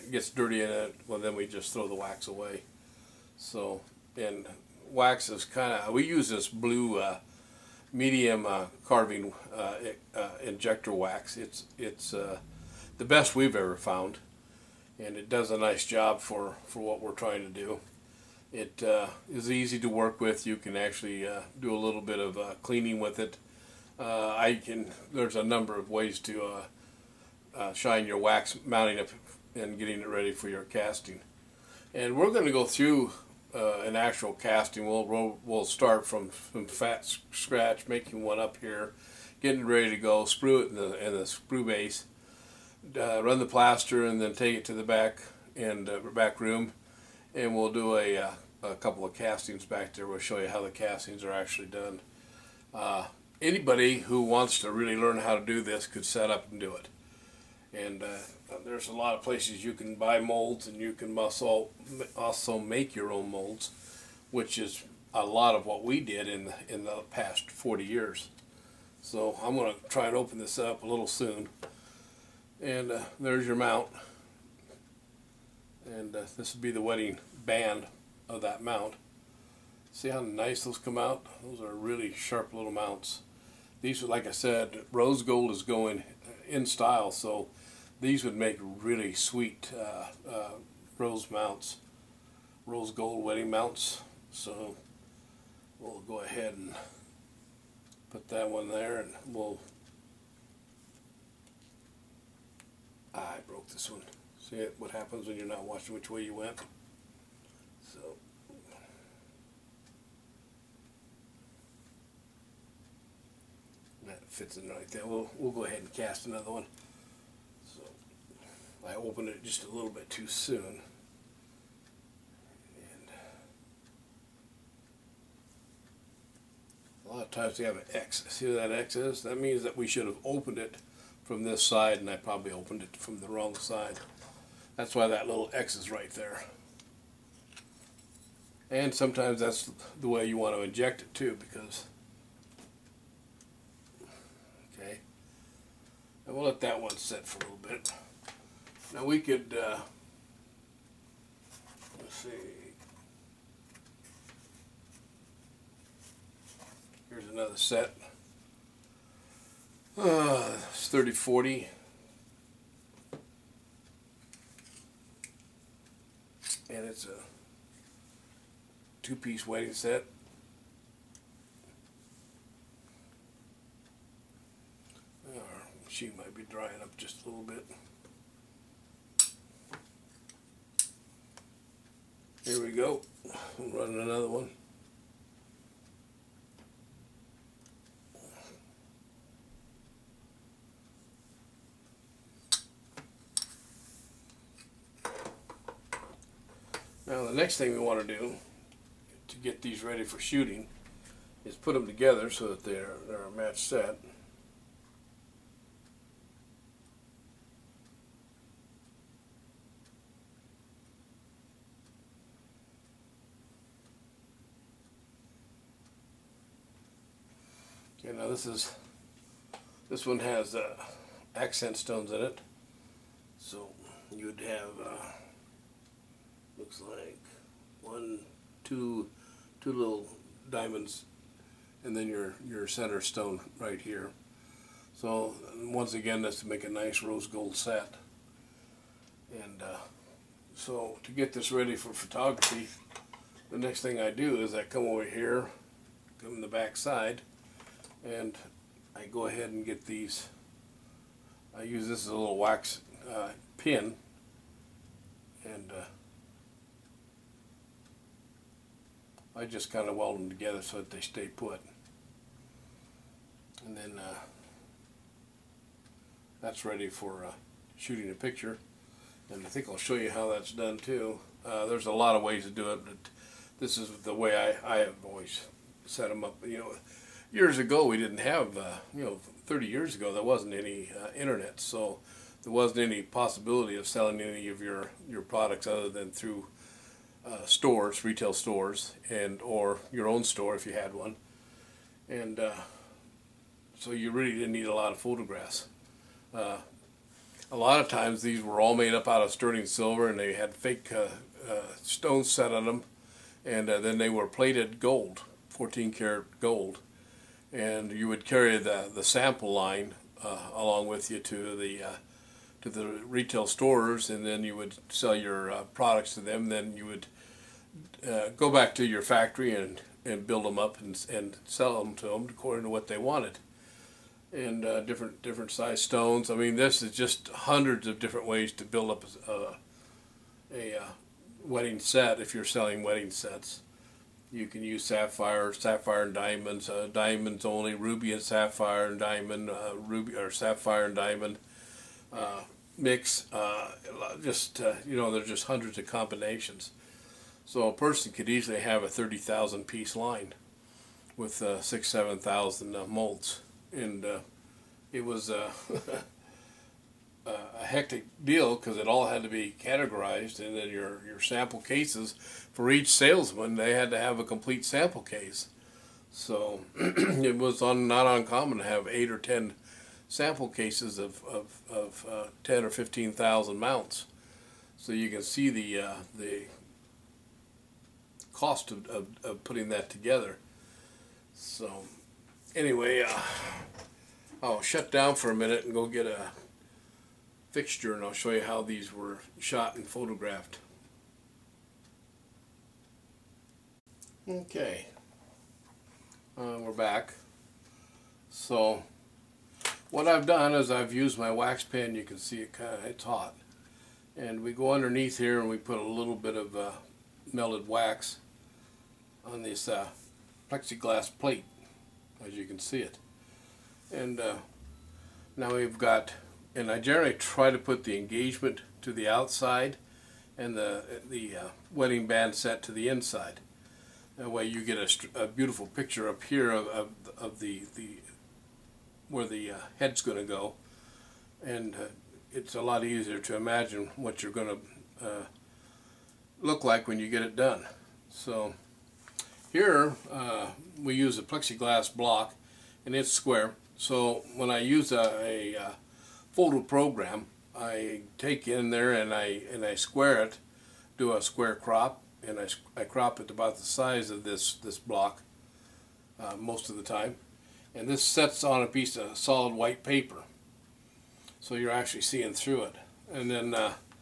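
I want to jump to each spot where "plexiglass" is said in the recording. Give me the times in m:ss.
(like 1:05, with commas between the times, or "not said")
6:50, 7:21.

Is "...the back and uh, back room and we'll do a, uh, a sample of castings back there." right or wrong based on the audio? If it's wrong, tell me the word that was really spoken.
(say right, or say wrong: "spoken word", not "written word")
wrong: "couple", not "sample".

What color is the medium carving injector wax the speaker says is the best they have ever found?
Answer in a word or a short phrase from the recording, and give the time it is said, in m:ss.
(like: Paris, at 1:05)
Blue, at 0:06.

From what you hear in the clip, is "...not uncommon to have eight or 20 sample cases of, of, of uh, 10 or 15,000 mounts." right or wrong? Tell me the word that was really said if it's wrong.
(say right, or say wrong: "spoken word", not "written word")
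wrong: "10", not "20".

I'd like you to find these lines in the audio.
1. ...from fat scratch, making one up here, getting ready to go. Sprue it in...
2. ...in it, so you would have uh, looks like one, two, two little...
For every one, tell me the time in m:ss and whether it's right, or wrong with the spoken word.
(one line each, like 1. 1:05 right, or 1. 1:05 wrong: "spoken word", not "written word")
1. 0:36 right
2. 3:42 right.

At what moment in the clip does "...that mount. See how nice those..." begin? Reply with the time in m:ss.
1:18.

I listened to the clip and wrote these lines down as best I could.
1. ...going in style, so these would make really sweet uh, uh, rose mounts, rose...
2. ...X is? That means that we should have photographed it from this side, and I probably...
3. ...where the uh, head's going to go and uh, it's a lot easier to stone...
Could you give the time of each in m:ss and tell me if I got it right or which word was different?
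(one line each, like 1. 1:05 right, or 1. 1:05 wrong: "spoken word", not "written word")
1. 1:25 right
2. 2:08 wrong: "opened", not "photographed"
3. 7:09 wrong: "imagine", not "stone".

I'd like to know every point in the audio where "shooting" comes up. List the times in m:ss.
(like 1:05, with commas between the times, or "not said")
3:20, 4:27.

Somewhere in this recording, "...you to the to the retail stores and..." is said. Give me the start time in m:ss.
5:11.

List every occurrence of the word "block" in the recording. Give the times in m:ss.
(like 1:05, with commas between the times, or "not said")
7:21, 7:34.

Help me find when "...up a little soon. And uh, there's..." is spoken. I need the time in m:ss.
1:10.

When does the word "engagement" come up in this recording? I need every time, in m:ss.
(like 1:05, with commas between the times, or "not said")
6:57.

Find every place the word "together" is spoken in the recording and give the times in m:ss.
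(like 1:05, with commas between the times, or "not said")
3:21, 4:20, 6:19.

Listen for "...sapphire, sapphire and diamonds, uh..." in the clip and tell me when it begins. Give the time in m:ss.
5:34.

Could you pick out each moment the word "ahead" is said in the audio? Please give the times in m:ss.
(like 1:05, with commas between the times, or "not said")
1:36, 1:55, 4:09.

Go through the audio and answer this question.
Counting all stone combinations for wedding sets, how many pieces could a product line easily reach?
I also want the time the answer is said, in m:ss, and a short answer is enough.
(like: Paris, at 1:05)
30,000, at 5:48.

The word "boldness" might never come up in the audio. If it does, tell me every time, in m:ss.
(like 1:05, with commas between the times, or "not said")
not said.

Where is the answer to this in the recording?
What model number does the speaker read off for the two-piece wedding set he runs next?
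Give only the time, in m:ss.
2:40.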